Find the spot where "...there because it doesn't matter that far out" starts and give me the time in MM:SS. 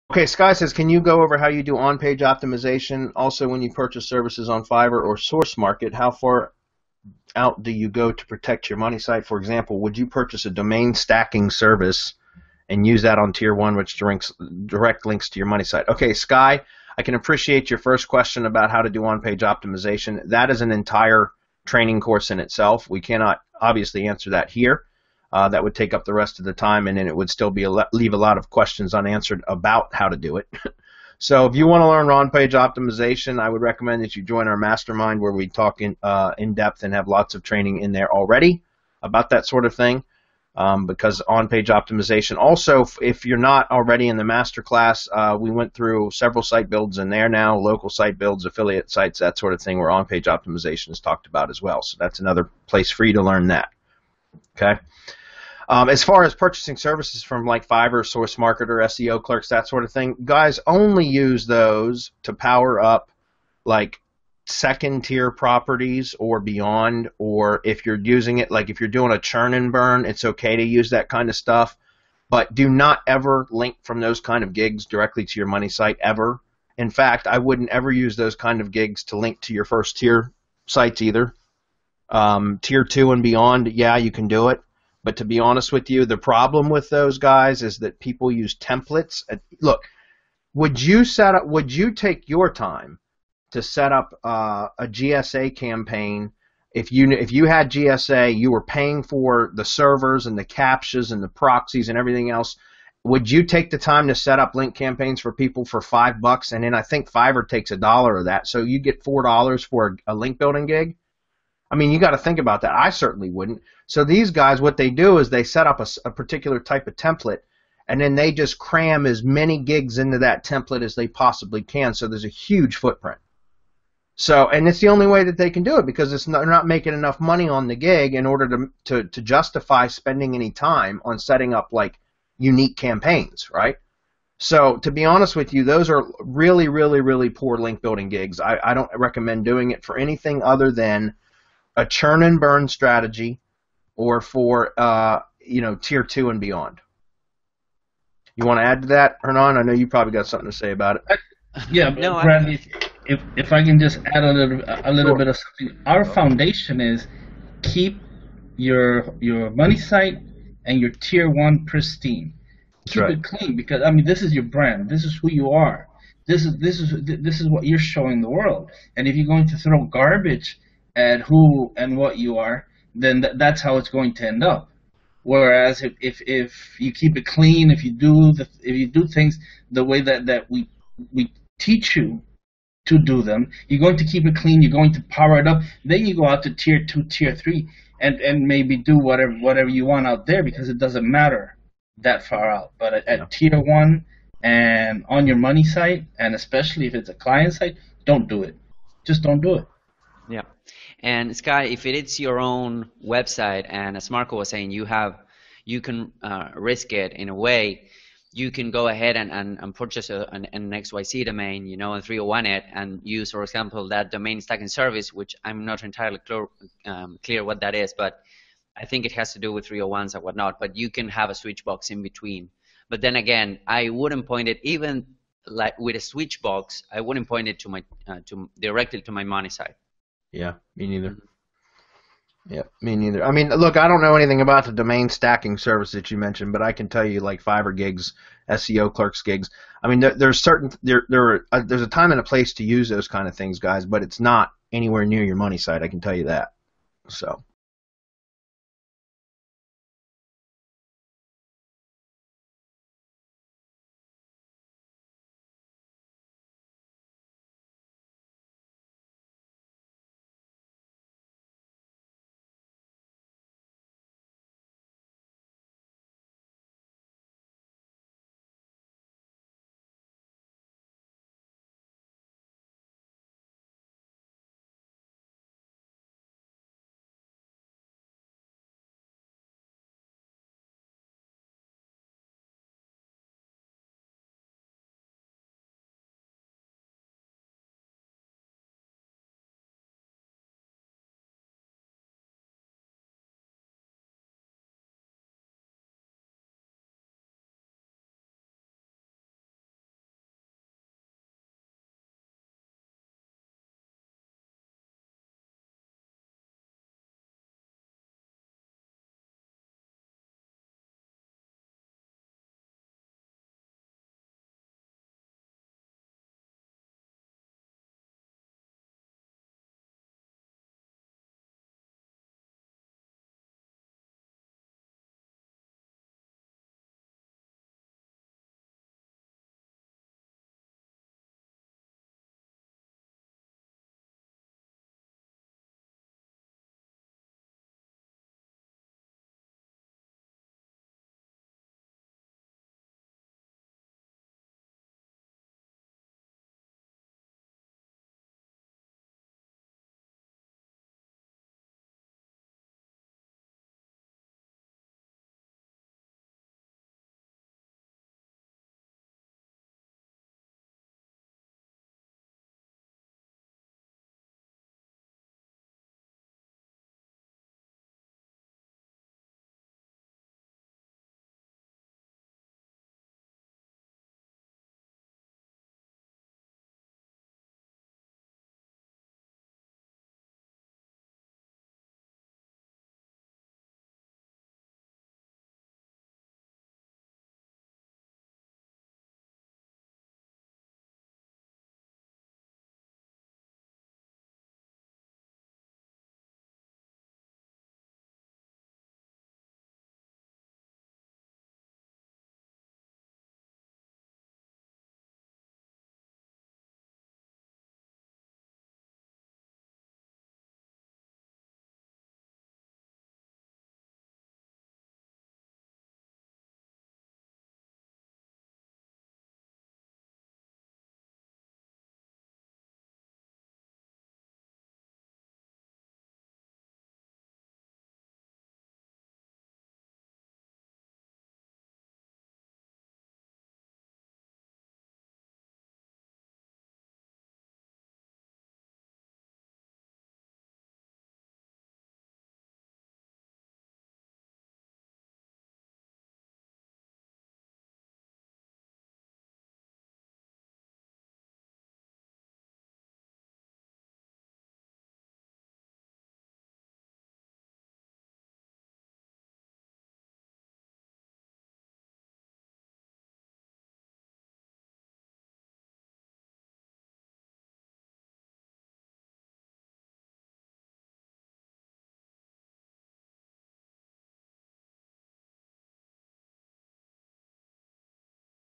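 03:10.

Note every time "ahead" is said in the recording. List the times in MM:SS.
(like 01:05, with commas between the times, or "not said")
03:28.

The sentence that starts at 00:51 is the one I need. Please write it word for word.
So that's another place for you to learn that.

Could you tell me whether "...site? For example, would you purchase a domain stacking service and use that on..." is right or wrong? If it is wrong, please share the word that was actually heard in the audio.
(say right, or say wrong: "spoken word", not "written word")
right.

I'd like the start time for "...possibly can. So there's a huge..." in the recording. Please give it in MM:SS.
02:01.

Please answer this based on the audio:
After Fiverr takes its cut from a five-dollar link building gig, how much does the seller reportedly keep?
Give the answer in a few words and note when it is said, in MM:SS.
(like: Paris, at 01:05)
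$4, at 01:49.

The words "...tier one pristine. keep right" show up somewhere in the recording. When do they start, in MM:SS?
02:40.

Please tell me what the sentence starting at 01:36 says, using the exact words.
If you if you had GSA, you were paying for the servers and the captchas and the proxies and everything else.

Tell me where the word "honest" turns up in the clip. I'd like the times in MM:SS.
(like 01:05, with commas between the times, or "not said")
01:25, 02:15.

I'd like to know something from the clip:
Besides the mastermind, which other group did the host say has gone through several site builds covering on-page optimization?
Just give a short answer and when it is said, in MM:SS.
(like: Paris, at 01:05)
masterclass, at 00:44.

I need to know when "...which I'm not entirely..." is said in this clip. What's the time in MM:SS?
03:35.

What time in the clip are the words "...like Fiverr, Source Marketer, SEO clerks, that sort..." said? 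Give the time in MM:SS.
00:57.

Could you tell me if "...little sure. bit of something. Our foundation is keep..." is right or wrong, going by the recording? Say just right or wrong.
right.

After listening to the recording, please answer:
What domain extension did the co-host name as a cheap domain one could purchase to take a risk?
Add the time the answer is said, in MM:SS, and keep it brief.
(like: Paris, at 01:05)
XYZ, at 03:30.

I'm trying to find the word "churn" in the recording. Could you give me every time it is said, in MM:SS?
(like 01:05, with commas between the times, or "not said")
01:09, 02:21.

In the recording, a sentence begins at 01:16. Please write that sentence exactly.
In fact, I wouldn't ever use those kind of gigs to link to your first tier sites either.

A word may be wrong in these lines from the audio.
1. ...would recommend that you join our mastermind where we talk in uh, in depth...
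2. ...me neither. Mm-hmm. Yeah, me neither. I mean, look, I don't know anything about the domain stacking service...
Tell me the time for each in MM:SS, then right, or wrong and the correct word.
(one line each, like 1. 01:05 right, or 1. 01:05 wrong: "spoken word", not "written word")
1. 00:33 right
2. 03:50 right.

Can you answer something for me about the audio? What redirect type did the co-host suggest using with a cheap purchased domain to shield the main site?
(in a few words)
301.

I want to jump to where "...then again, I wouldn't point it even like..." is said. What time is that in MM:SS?
03:43.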